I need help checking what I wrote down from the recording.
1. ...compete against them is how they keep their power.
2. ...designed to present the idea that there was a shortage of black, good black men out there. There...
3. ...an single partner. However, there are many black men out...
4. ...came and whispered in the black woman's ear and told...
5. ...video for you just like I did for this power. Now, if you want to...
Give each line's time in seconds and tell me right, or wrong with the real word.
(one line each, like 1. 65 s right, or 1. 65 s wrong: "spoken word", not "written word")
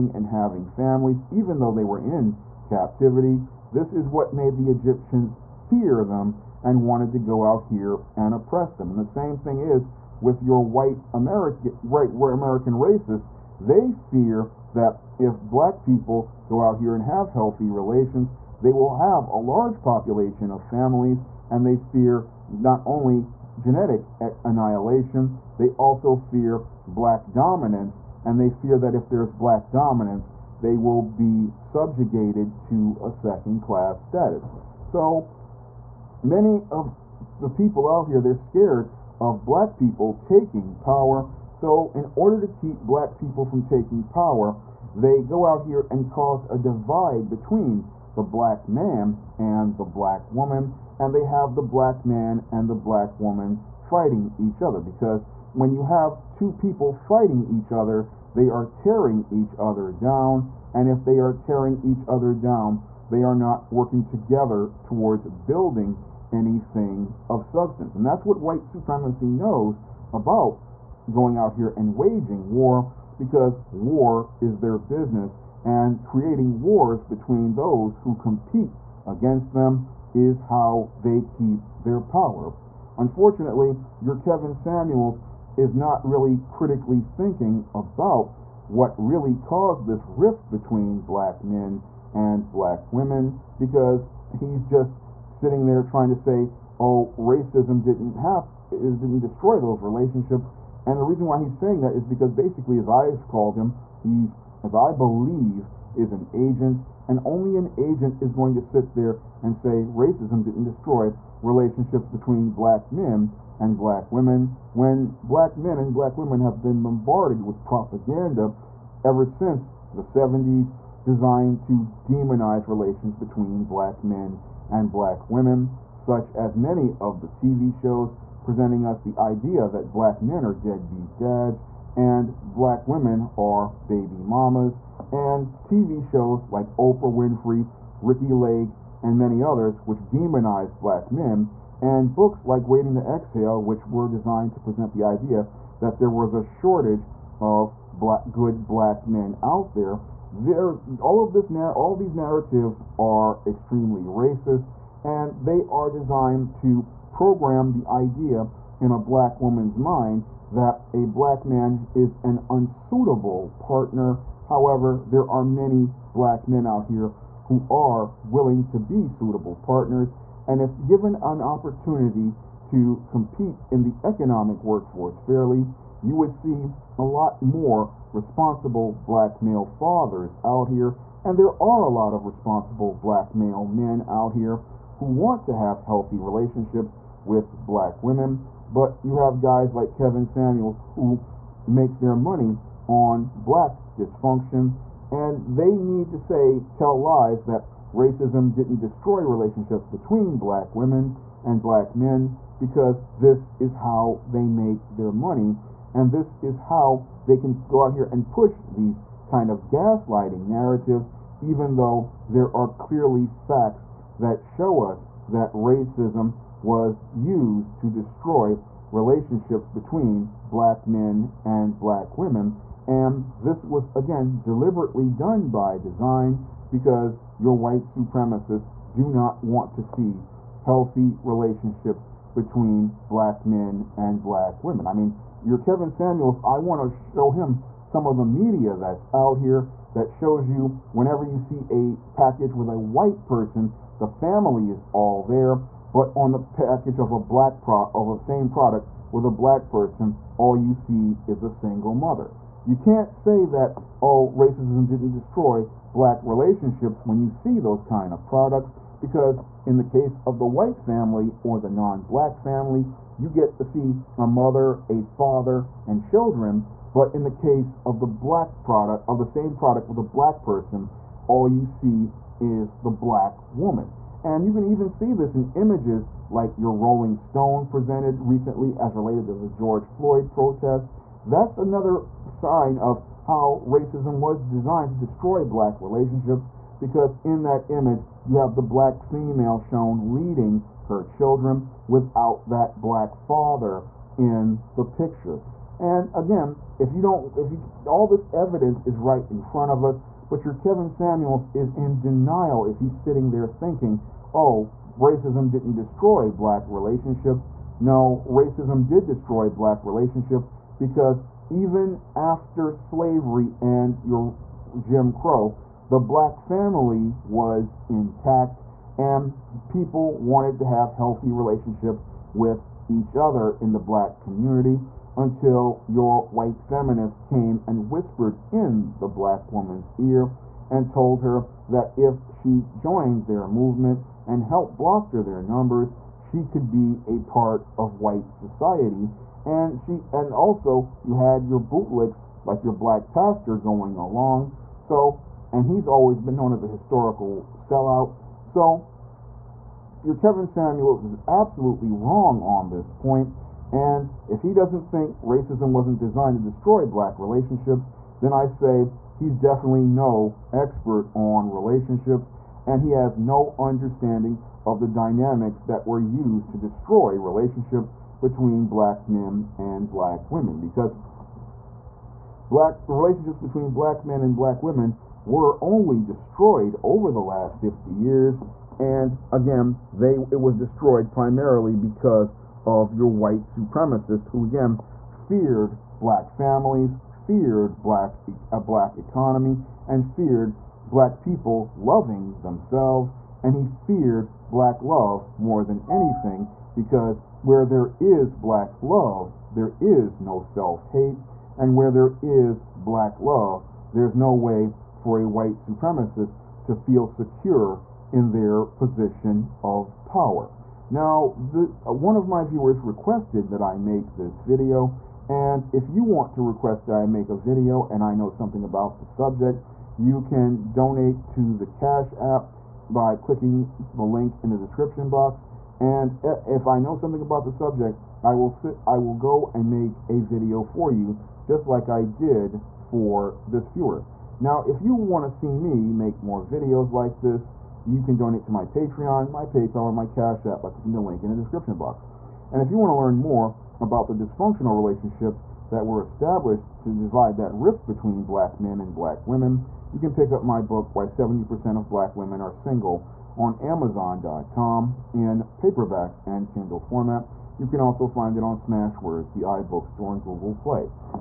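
1. 78 s right
2. 144 s right
3. 162 s wrong: "unsuitable", not "single"
4. 327 s right
5. 430 s wrong: "viewer", not "power".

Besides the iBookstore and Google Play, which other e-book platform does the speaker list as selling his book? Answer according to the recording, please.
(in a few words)
Smashwords.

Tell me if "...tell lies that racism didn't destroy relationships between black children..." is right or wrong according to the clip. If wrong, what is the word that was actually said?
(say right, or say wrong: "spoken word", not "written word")
wrong: "women", not "children".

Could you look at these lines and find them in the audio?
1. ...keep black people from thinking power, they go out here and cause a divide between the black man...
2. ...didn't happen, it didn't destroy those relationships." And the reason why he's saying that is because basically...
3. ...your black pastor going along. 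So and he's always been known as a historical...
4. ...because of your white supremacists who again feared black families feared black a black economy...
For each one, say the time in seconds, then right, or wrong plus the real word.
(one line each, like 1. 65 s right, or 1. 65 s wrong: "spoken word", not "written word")
1. 42 s wrong: "taking", not "thinking"
2. 97 s right
3. 342 s right
4. 381 s right.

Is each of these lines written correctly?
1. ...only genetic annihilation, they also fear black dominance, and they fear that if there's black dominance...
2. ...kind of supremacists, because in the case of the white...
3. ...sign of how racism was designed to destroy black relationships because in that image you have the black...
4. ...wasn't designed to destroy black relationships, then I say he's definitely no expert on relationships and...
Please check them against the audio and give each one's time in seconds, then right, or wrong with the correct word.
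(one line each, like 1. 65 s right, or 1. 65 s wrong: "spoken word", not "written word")
1. 22 s right
2. 257 s wrong: "products", not "supremacists"
3. 282 s right
4. 355 s right.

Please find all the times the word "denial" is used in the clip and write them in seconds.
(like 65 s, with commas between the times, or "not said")
301 s.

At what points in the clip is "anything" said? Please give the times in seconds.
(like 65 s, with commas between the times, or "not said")
66 s, 395 s.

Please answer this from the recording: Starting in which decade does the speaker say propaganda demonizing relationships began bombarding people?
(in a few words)
the 70s.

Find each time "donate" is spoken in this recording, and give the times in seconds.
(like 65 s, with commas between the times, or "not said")
420 s, 438 s.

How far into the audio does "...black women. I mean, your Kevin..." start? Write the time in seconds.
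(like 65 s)
234 s.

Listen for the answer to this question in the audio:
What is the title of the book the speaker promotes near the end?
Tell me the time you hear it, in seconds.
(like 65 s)
450 s.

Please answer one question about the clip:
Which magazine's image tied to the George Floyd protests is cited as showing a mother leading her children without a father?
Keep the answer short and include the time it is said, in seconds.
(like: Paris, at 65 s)
Rolling Stone, at 276 s.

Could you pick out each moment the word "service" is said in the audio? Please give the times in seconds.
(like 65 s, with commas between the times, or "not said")
not said.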